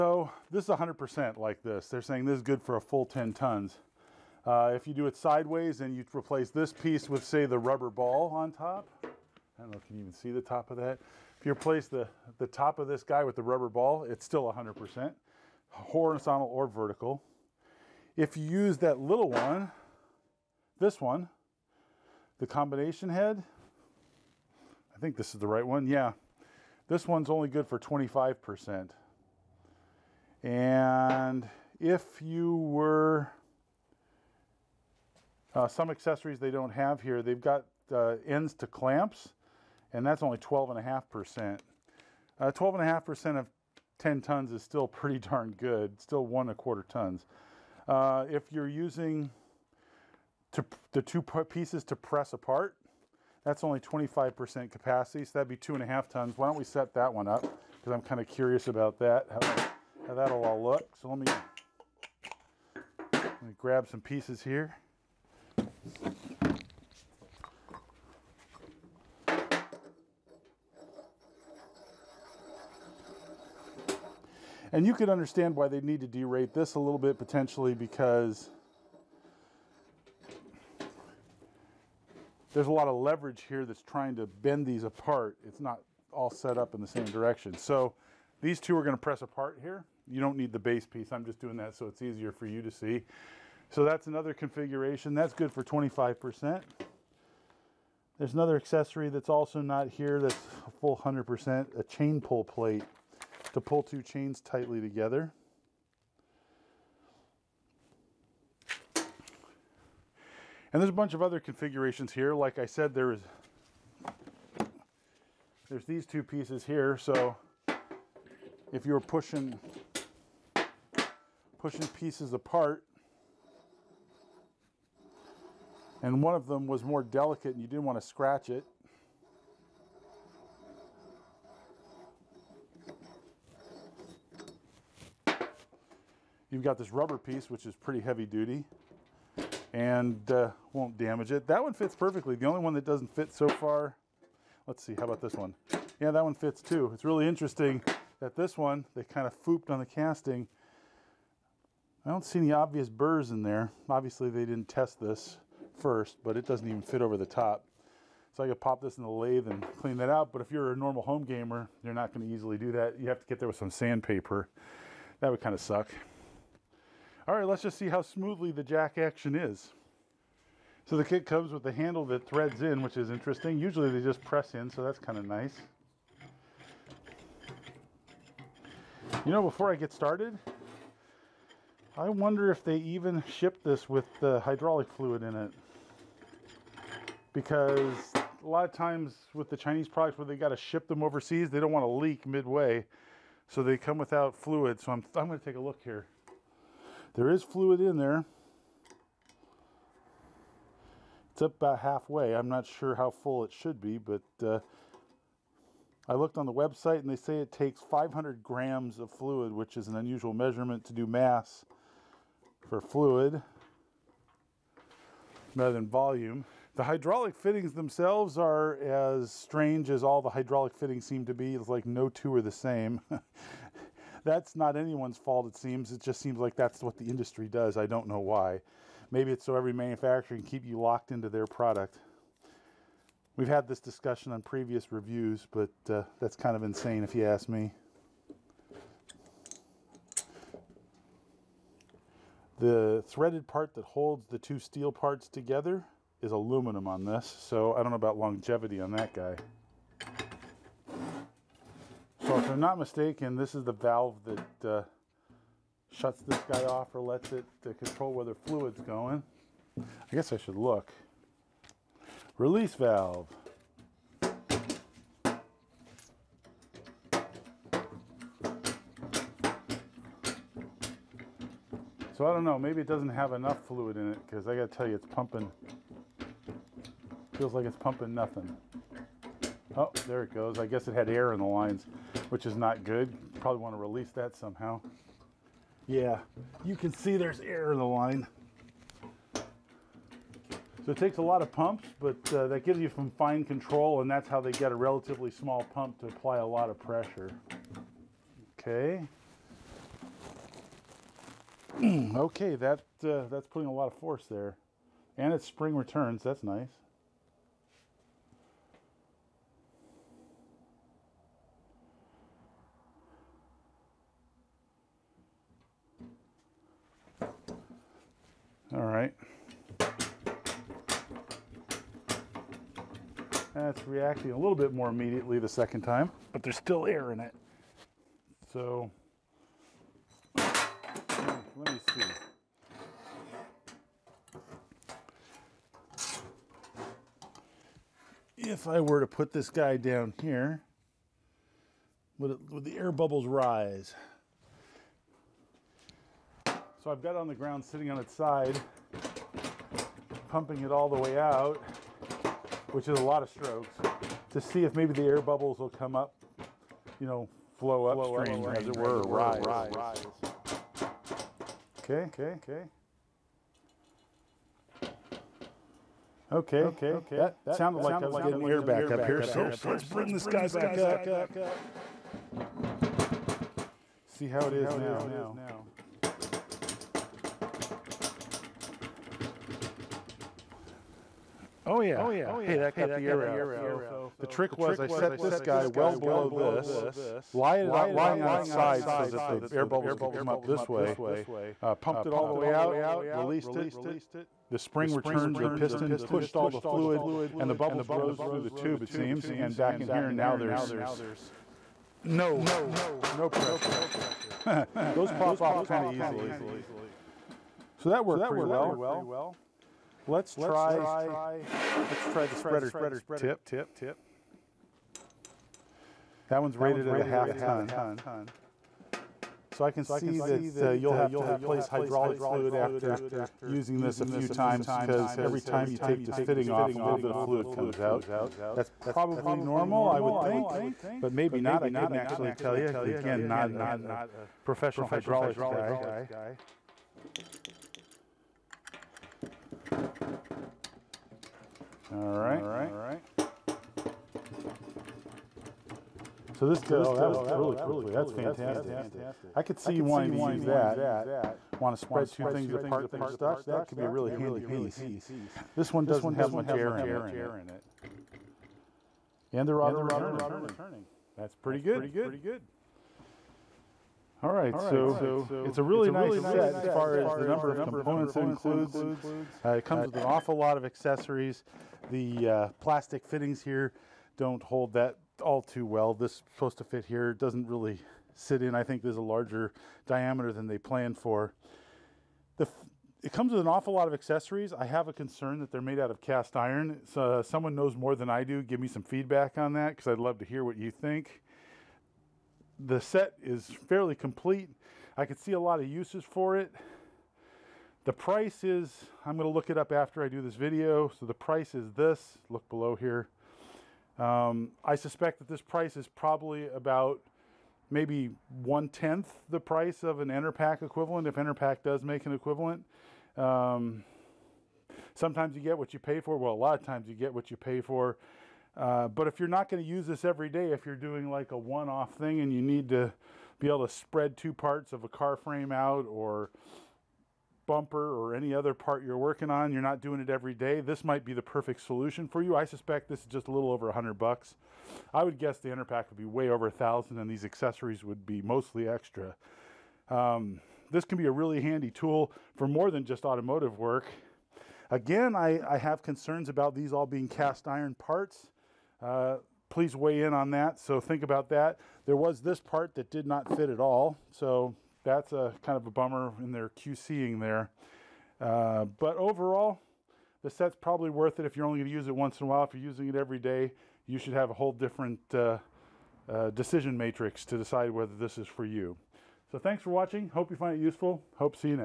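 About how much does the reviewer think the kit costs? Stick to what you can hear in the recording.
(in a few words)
just over $100.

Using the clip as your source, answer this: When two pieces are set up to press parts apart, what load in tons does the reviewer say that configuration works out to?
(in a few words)
2.5 tons.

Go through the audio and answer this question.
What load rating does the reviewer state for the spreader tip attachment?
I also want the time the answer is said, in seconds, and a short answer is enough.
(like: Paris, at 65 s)
half ton, at 416 s.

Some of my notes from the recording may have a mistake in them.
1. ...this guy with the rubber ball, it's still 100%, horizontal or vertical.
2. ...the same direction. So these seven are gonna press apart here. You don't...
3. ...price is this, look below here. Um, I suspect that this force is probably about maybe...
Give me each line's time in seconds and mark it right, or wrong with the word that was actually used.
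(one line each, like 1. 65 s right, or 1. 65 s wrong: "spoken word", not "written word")
1. 12 s right
2. 86 s wrong: "two", not "seven"
3. 501 s wrong: "price", not "force".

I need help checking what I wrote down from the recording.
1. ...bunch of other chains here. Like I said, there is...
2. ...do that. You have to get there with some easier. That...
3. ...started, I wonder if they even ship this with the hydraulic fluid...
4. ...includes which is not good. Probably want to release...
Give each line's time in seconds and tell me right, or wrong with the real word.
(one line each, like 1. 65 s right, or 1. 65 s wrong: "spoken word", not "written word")
1. 110 s wrong: "configurations", not "chains"
2. 162 s wrong: "sandpaper", not "easier"
3. 179 s right
4. 281 s wrong: "lines", not "includes".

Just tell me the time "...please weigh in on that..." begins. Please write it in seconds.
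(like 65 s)
549 s.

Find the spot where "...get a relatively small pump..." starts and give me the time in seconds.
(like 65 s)
294 s.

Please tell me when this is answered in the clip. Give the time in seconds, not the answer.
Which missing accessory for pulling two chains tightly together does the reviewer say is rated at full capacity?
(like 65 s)
101 s.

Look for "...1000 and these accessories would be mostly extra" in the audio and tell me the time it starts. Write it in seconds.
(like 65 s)
536 s.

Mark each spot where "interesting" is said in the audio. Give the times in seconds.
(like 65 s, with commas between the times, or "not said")
147 s, 173 s.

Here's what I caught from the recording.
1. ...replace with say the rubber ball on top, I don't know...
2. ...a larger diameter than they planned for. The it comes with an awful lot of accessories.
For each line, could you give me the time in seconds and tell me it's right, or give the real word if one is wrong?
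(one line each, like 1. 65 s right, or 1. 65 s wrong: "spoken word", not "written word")
1. 6 s wrong: "piece", not "replace"
2. 478 s right.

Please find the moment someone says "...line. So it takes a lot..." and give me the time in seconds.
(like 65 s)
287 s.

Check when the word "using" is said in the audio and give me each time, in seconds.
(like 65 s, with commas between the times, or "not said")
48 s, 423 s, 562 s.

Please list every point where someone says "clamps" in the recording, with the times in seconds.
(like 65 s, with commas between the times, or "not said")
38 s.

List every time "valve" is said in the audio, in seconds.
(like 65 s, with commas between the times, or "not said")
253 s, 262 s.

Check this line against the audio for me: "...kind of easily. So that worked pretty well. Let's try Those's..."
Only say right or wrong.
wrong.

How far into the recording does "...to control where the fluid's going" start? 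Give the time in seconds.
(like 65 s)
257 s.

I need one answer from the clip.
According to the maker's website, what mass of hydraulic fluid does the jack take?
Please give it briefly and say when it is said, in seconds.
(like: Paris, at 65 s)
500 grams, at 207 s.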